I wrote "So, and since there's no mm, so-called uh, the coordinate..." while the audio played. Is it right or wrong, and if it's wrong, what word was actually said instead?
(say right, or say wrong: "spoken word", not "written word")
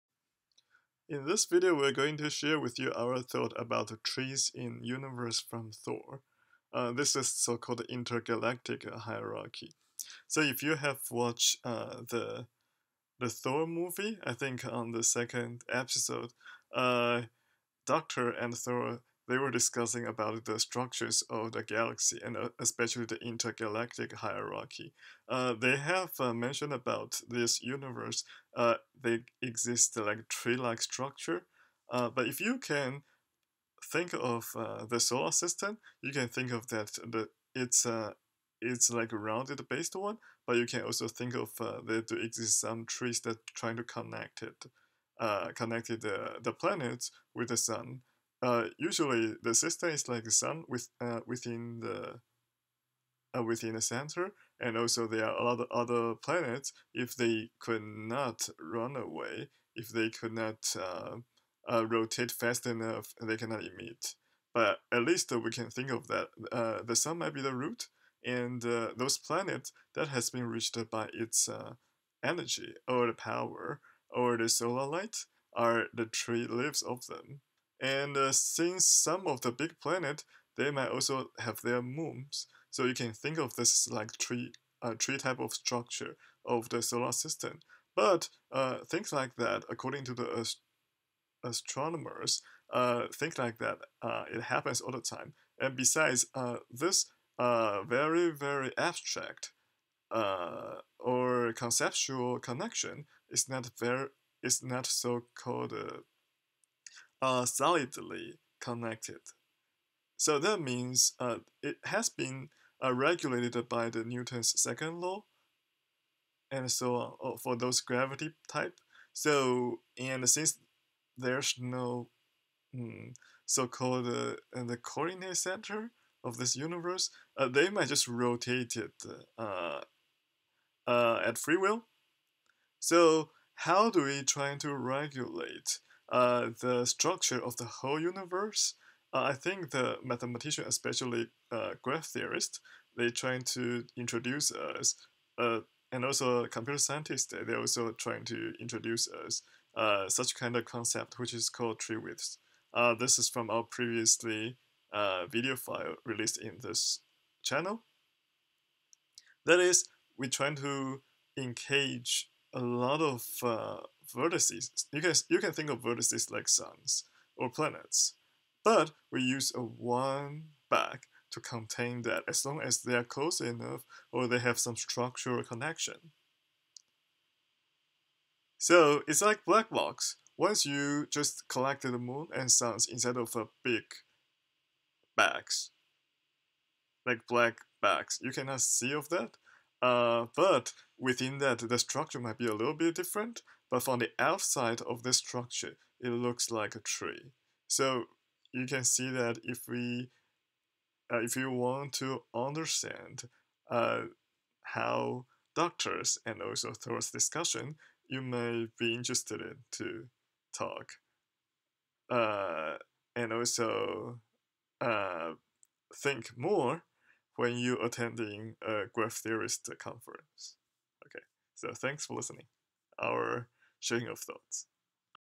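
right.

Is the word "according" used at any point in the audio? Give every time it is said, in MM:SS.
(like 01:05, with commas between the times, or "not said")
01:29.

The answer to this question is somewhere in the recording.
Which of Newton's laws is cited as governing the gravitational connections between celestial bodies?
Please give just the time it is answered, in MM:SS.
01:54.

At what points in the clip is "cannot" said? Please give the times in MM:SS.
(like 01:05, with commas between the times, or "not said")
01:03, 03:08.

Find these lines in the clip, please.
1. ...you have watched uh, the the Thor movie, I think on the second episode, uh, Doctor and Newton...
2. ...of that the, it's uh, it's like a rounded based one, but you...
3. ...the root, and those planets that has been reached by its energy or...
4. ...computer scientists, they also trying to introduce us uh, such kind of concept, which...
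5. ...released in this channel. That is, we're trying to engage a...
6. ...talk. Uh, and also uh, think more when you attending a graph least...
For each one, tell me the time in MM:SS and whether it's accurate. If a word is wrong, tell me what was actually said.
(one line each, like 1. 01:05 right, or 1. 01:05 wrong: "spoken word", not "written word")
1. 00:10 wrong: "Thor", not "Newton"
2. 00:36 right
3. 01:07 right
4. 02:26 right
5. 02:36 right
6. 03:30 wrong: "theorist", not "least".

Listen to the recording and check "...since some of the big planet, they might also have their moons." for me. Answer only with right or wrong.
right.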